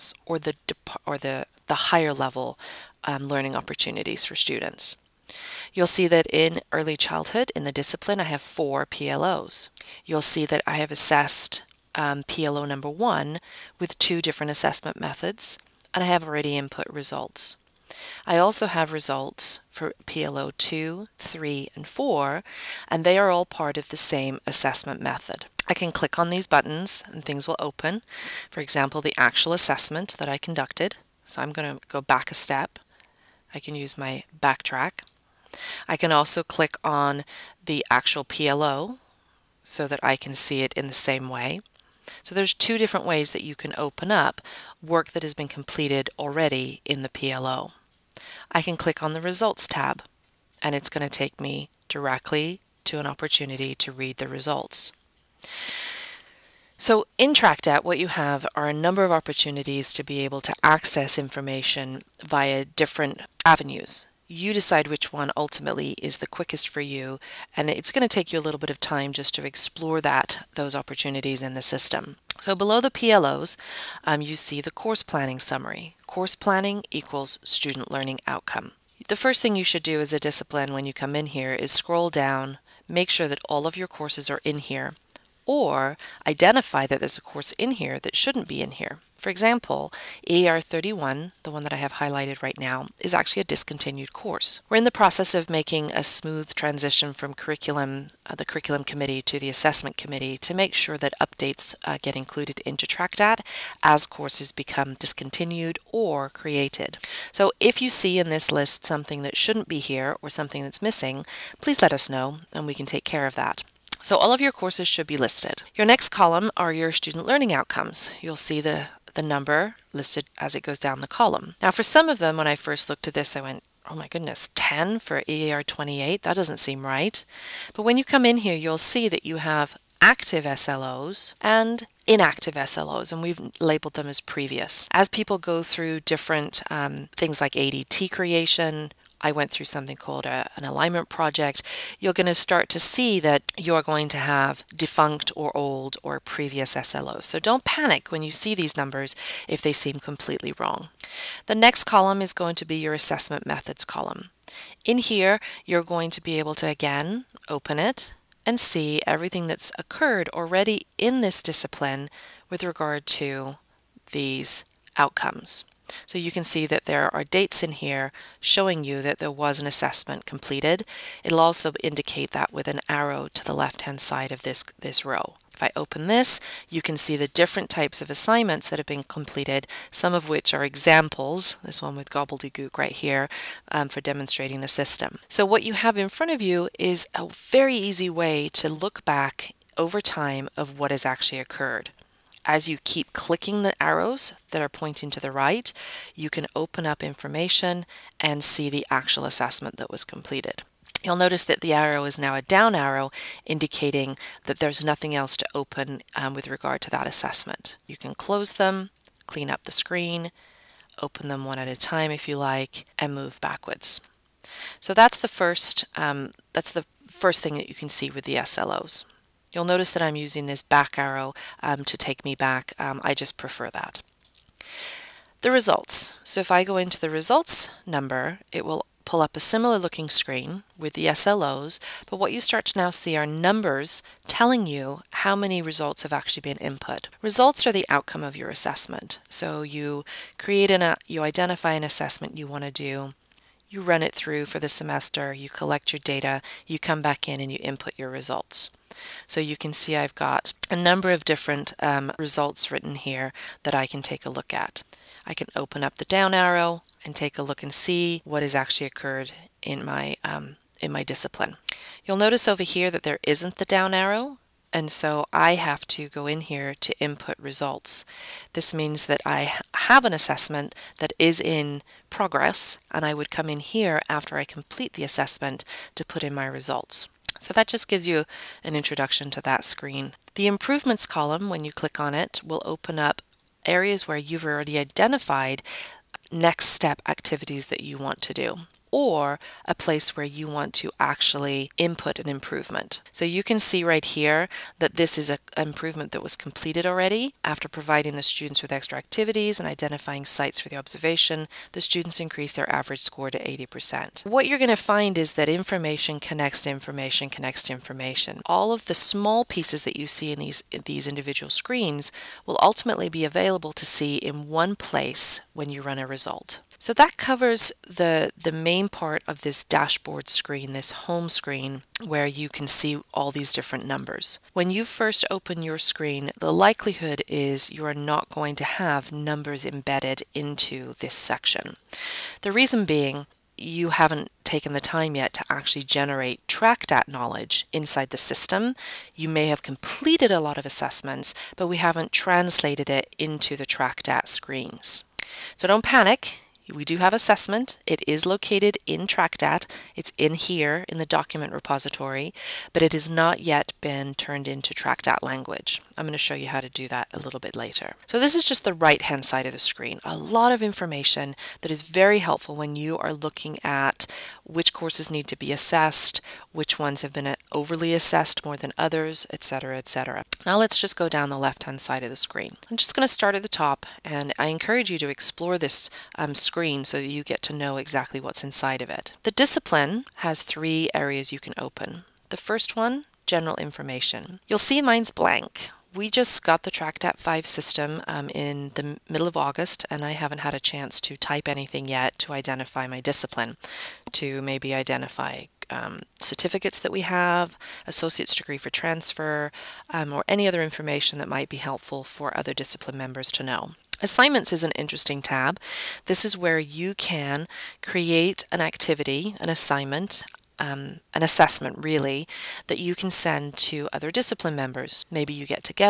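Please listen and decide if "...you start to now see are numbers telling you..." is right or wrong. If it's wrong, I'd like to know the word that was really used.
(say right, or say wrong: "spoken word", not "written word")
right.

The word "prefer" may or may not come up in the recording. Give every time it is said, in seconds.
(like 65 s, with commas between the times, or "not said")
223 s.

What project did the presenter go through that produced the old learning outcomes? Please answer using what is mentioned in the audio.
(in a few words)
An alignment project.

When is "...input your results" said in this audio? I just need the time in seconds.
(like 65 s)
247 s.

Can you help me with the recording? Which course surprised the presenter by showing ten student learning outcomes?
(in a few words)
EAR28.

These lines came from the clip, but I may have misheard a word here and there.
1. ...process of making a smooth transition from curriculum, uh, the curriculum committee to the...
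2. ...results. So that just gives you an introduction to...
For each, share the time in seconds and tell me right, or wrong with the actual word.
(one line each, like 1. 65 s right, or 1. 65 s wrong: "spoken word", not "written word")
1. 94 s right
2. 276 s right.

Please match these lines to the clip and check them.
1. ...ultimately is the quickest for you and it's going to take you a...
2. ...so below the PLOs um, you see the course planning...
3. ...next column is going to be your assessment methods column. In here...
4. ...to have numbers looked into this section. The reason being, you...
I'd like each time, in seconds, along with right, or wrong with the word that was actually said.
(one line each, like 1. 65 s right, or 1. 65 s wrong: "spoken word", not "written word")
1. 65 s right
2. 72 s right
3. 151 s right
4. 328 s wrong: "embedded", not "looked".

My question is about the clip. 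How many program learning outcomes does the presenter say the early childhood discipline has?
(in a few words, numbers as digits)
4.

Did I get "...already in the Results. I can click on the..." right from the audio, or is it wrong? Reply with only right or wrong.
wrong.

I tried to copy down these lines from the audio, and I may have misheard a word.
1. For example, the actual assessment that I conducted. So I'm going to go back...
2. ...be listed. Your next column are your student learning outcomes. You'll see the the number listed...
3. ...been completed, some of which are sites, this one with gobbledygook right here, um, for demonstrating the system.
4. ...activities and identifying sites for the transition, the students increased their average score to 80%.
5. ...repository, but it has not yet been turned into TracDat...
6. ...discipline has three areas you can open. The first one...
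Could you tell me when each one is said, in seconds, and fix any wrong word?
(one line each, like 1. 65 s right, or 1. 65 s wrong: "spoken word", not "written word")
1. 28 s right
2. 115 s right
3. 178 s wrong: "examples", not "sites"
4. 298 s wrong: "observation", not "transition"
5. 351 s right
6. 379 s right.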